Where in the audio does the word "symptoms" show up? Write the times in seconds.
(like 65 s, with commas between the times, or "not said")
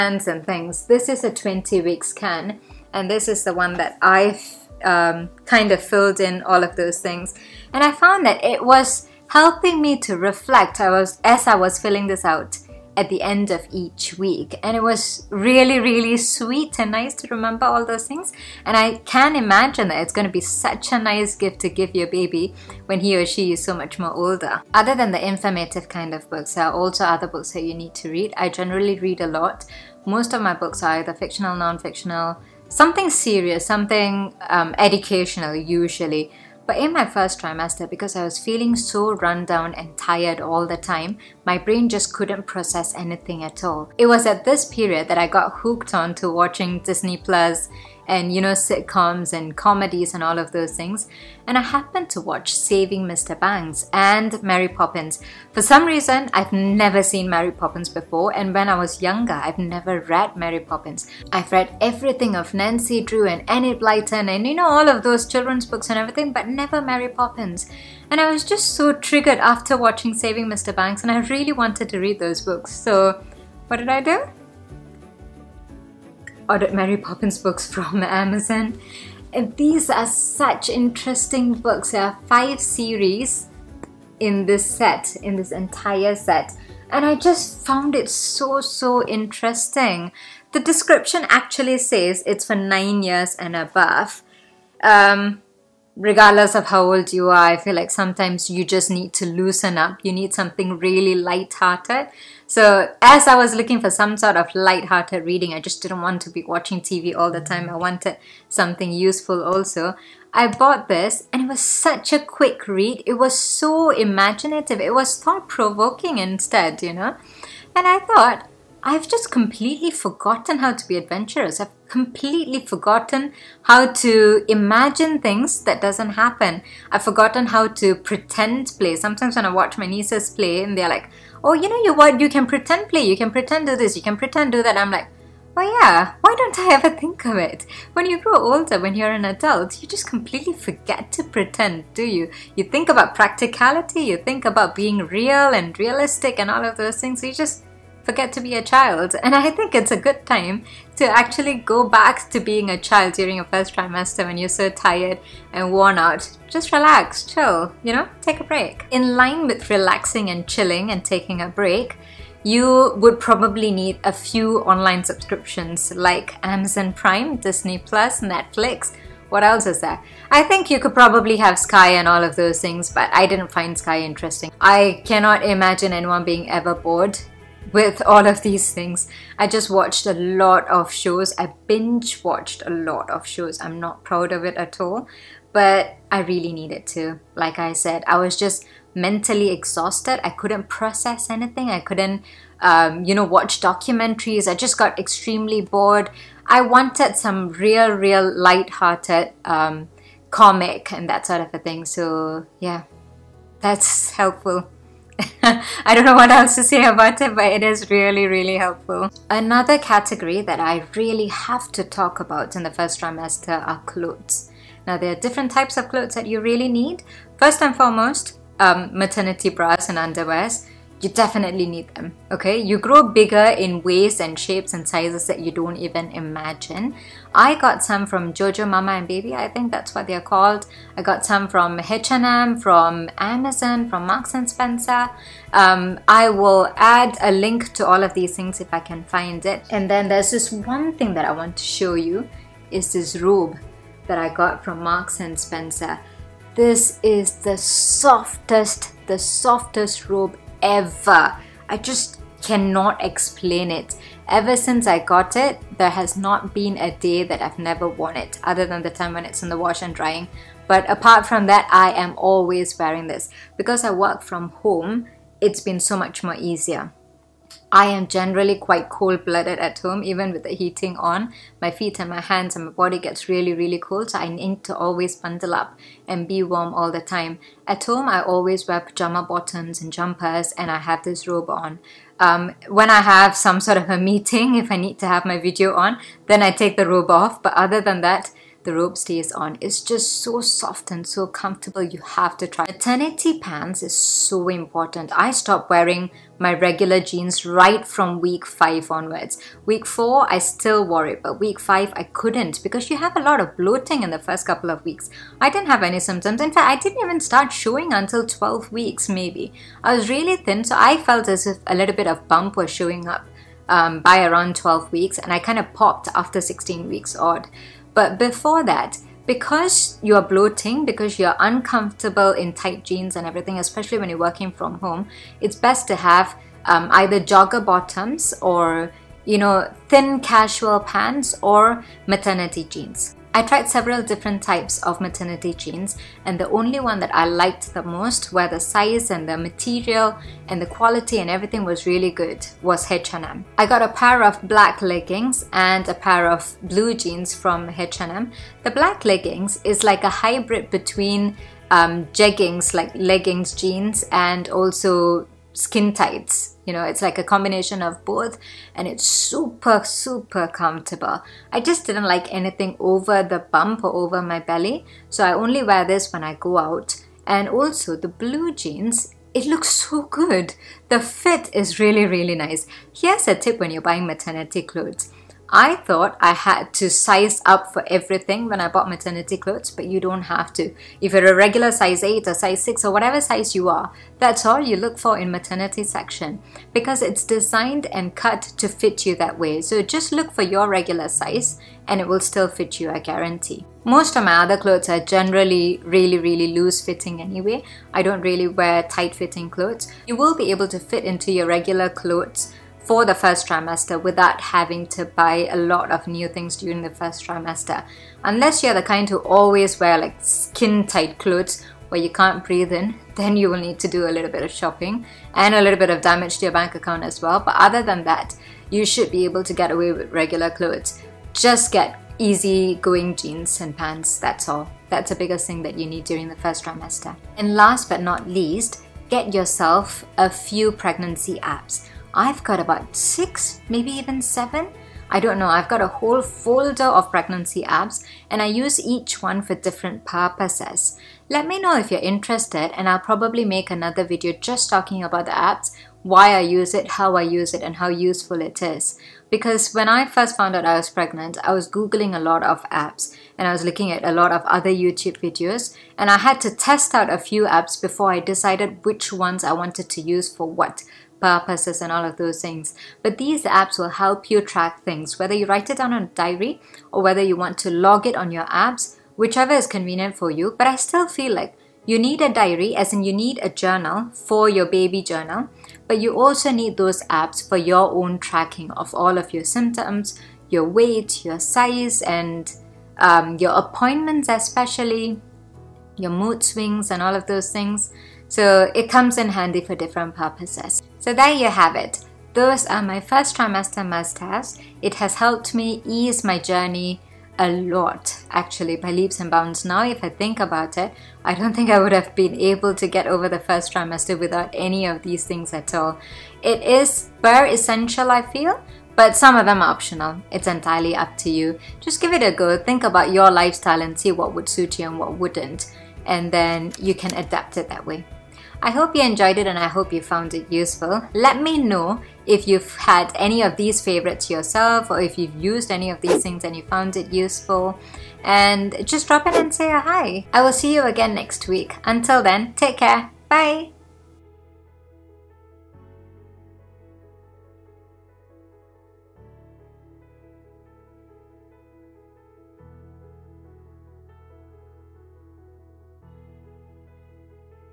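305 s, 479 s.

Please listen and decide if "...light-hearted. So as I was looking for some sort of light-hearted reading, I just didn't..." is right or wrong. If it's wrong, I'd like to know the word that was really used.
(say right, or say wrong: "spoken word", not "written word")
right.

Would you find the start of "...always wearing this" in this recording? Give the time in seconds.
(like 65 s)
262 s.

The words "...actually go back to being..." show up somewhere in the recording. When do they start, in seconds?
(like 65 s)
151 s.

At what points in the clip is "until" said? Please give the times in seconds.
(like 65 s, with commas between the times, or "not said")
307 s, 531 s.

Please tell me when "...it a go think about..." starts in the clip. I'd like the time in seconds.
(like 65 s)
512 s.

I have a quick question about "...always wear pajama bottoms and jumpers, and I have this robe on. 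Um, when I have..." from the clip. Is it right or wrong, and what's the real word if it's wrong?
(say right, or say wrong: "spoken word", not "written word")
right.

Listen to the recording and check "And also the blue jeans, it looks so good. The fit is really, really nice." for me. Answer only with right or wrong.
right.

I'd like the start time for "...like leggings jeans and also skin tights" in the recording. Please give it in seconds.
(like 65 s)
352 s.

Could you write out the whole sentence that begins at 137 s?
When you grow older, when you're an adult, you just completely forget to pretend, do you?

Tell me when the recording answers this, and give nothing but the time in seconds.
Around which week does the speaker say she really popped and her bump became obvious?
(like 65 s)
316 s.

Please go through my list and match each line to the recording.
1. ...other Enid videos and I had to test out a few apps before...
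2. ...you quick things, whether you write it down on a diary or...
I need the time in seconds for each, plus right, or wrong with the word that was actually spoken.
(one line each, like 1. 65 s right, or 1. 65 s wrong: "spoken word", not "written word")
1. 454 s wrong: "YouTube", not "Enid"
2. 464 s wrong: "track", not "quick".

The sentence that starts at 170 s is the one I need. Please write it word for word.
I think you could probably have Sky and all of those things, but I didn't find Sky interesting.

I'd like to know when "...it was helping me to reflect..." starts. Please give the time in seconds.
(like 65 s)
8 s.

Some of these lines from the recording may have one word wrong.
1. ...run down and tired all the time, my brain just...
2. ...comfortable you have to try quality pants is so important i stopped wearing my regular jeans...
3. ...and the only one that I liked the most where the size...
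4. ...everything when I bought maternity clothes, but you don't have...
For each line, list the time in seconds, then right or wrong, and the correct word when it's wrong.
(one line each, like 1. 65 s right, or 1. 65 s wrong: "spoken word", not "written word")
1. 39 s right
2. 291 s wrong: "maternity", not "quality"
3. 336 s right
4. 377 s right.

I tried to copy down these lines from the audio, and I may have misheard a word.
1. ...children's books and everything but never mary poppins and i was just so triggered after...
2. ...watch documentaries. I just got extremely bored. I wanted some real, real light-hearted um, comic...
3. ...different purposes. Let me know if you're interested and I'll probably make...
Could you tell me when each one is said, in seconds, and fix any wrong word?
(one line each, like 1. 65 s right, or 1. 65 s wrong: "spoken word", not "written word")
1. 65 s right
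2. 193 s right
3. 439 s right.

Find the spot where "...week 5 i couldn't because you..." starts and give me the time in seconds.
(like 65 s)
301 s.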